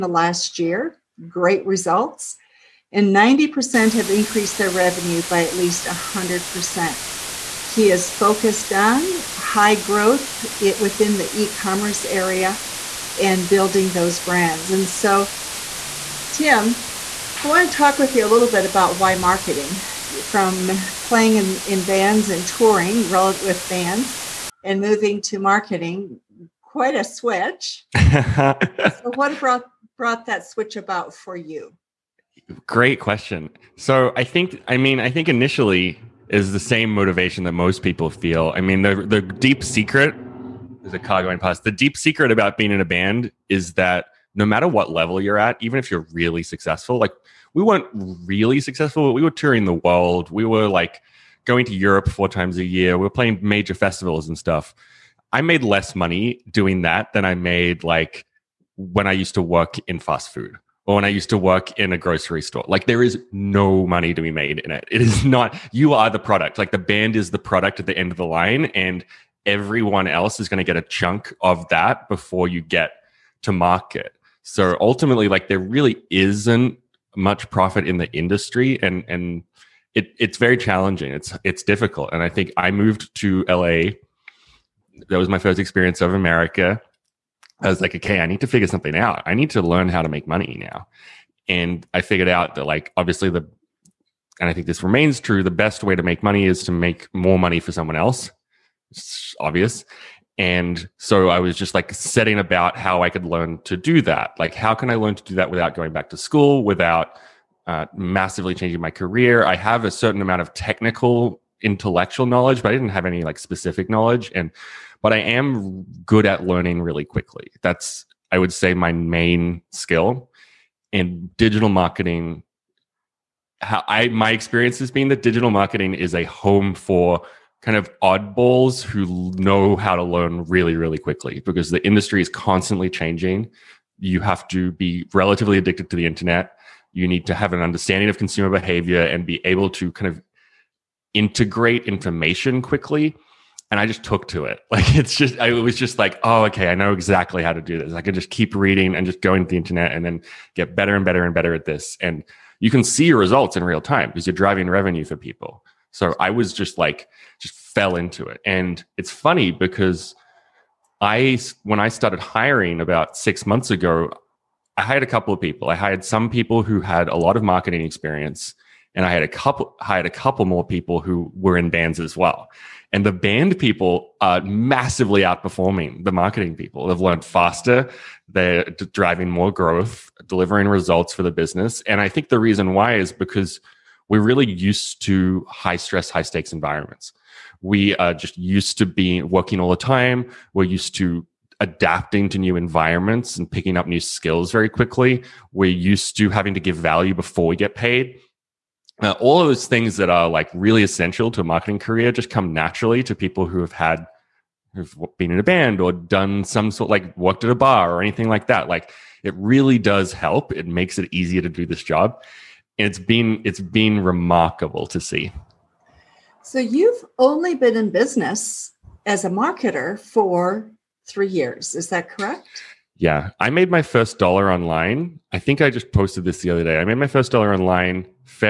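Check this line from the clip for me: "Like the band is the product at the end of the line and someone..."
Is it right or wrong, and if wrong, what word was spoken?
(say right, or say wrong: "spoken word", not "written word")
wrong: "everyone", not "someone".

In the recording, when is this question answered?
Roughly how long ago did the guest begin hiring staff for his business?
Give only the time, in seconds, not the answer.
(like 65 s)
163 s.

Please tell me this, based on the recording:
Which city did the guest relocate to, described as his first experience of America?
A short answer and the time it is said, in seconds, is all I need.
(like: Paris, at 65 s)
LA, at 83 s.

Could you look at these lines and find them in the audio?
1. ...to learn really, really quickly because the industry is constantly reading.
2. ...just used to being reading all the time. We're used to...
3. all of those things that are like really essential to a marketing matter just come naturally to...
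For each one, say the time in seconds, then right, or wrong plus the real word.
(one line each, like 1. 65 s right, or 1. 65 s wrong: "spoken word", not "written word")
1. 129 s wrong: "changing", not "reading"
2. 188 s wrong: "working", not "reading"
3. 199 s wrong: "career", not "matter".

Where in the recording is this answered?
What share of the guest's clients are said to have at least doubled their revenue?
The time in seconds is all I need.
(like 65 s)
3 s.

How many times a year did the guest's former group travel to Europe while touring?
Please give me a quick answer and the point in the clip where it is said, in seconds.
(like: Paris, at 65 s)
4, at 52 s.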